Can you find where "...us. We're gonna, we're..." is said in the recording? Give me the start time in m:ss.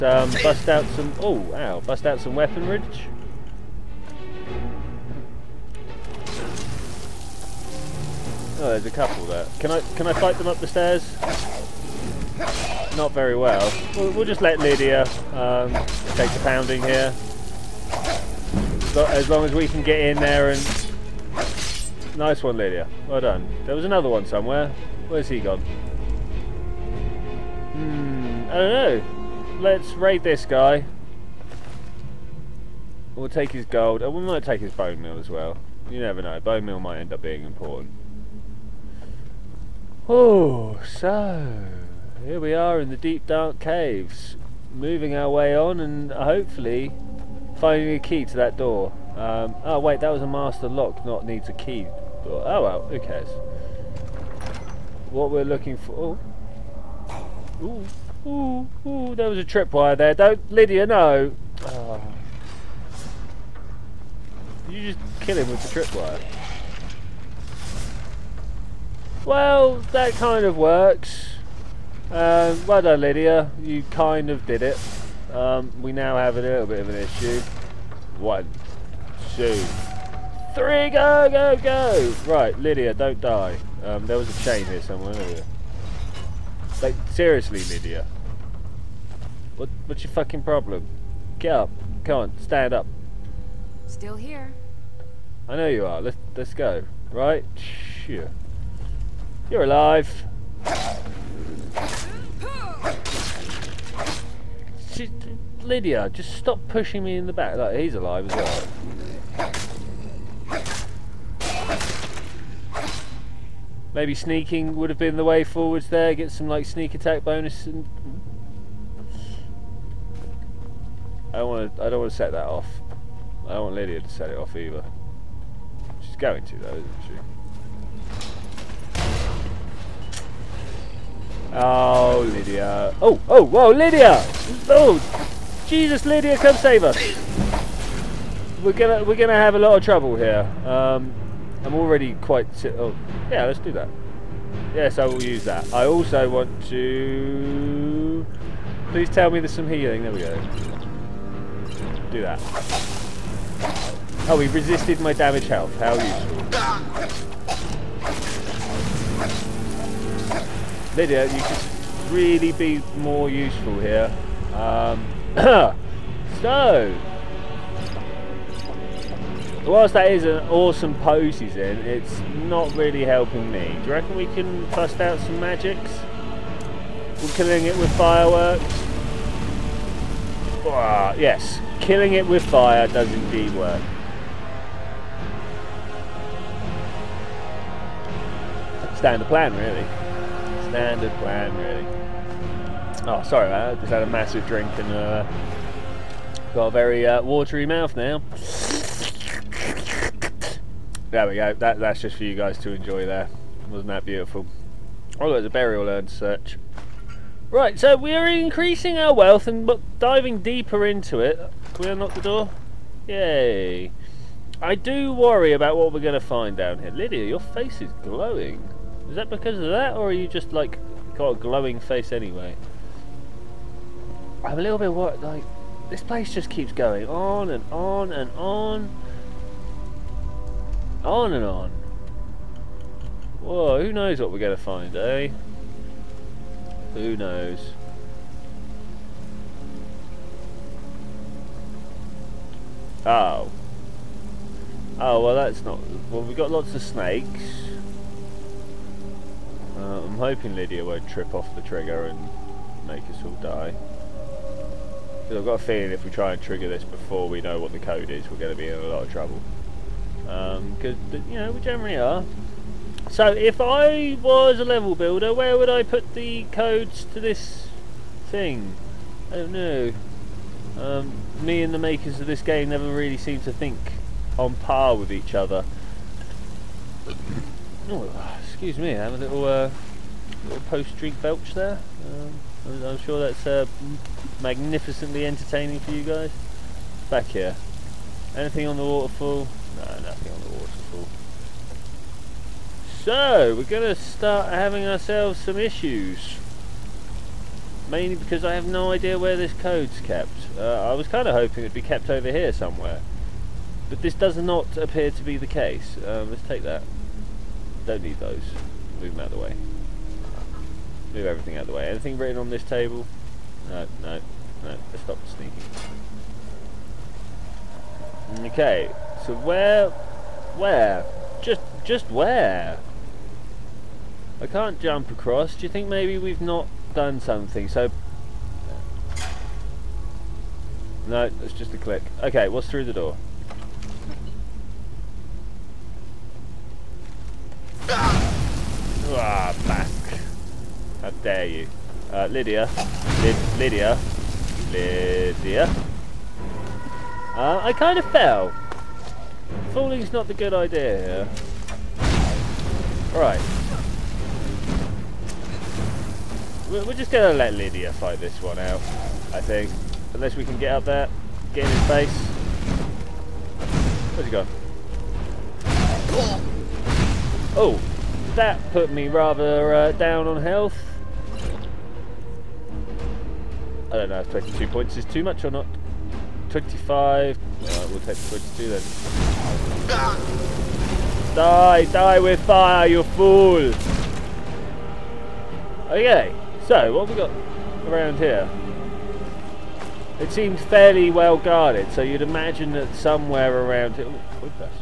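2:16.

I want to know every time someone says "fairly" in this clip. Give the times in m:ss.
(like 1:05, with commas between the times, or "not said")
6:30.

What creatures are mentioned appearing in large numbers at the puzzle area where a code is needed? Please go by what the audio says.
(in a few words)
Snakes.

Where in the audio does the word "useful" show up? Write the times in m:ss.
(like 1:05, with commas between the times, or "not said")
2:35, 2:43.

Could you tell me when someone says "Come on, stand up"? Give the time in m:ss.
1:32.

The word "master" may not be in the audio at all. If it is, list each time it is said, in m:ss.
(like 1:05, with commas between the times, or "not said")
0:50.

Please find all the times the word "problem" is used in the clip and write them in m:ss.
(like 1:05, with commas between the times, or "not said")
1:30.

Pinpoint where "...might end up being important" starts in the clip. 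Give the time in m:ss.
0:36.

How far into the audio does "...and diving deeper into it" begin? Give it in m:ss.
3:29.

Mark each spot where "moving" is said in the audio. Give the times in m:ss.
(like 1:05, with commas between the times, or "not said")
0:44.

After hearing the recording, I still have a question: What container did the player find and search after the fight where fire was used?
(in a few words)
Burial urn.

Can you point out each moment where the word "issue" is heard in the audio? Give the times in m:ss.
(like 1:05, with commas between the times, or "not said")
1:16, 4:55.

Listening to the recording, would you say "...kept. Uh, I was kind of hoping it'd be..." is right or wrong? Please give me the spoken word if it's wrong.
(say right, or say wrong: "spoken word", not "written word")
right.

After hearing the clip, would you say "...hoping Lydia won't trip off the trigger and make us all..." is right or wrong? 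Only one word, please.
right.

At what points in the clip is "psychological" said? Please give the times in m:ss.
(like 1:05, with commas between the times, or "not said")
not said.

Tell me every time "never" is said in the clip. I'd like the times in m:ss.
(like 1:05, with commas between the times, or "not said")
0:35, 4:32.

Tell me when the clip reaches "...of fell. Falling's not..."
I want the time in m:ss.
5:47.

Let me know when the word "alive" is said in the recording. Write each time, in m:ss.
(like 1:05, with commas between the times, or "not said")
1:39, 1:47.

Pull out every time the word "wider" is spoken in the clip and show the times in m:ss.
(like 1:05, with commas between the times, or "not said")
not said.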